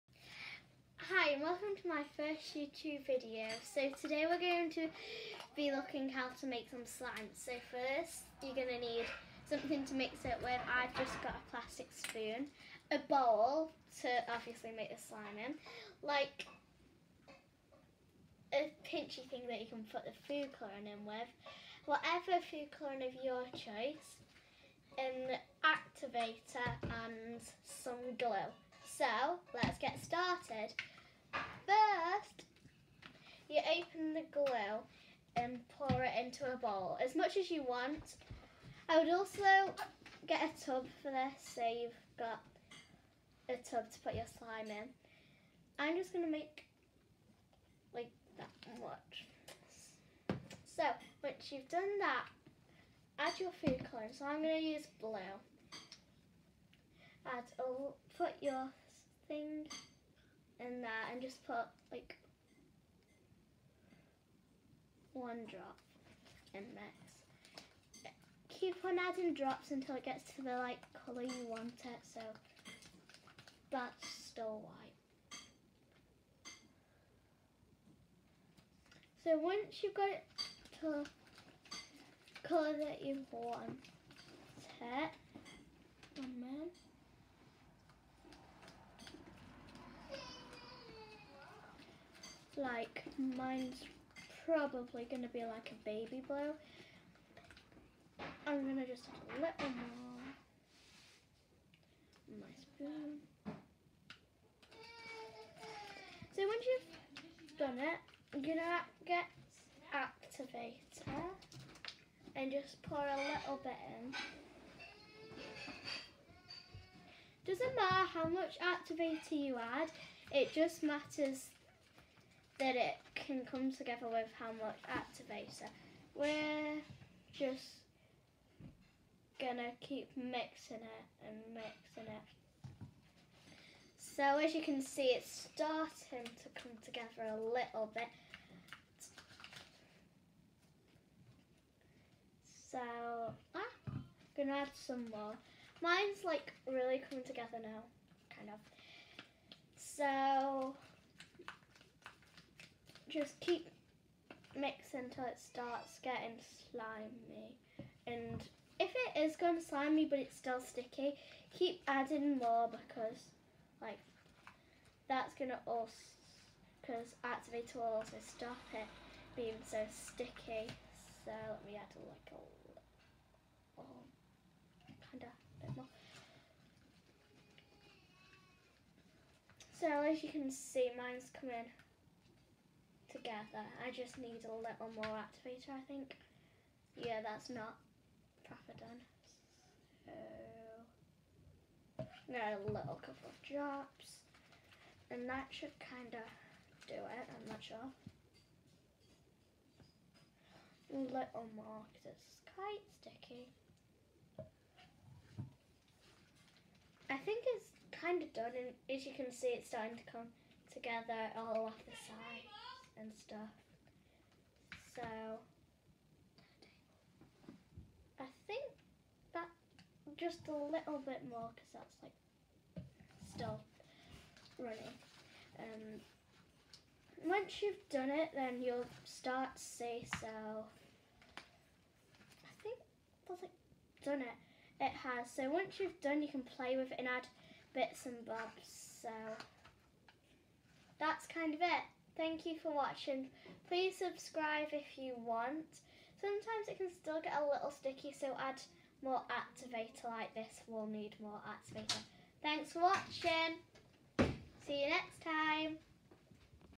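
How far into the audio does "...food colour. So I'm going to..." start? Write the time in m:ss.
0:53.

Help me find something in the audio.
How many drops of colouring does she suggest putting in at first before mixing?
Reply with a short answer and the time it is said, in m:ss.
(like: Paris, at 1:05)
1, at 1:05.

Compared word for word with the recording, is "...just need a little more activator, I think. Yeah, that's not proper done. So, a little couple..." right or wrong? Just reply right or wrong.
right.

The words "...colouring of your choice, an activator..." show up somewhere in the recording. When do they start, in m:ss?
0:22.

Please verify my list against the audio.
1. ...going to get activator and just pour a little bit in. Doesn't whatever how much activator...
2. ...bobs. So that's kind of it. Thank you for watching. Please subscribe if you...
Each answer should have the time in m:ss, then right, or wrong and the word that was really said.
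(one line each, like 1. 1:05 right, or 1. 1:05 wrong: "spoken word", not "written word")
1. 1:48 wrong: "matter", not "whatever"
2. 3:58 right.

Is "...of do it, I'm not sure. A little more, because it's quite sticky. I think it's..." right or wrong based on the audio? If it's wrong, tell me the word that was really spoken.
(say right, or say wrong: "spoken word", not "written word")
right.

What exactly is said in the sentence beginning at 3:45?
Um, once you've done it, then you'll start to see.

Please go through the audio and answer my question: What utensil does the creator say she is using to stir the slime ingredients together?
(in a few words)
plastic spoon.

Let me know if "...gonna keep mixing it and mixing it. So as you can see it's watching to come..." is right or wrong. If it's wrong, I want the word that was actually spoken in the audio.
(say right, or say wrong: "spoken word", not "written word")
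wrong: "starting", not "watching".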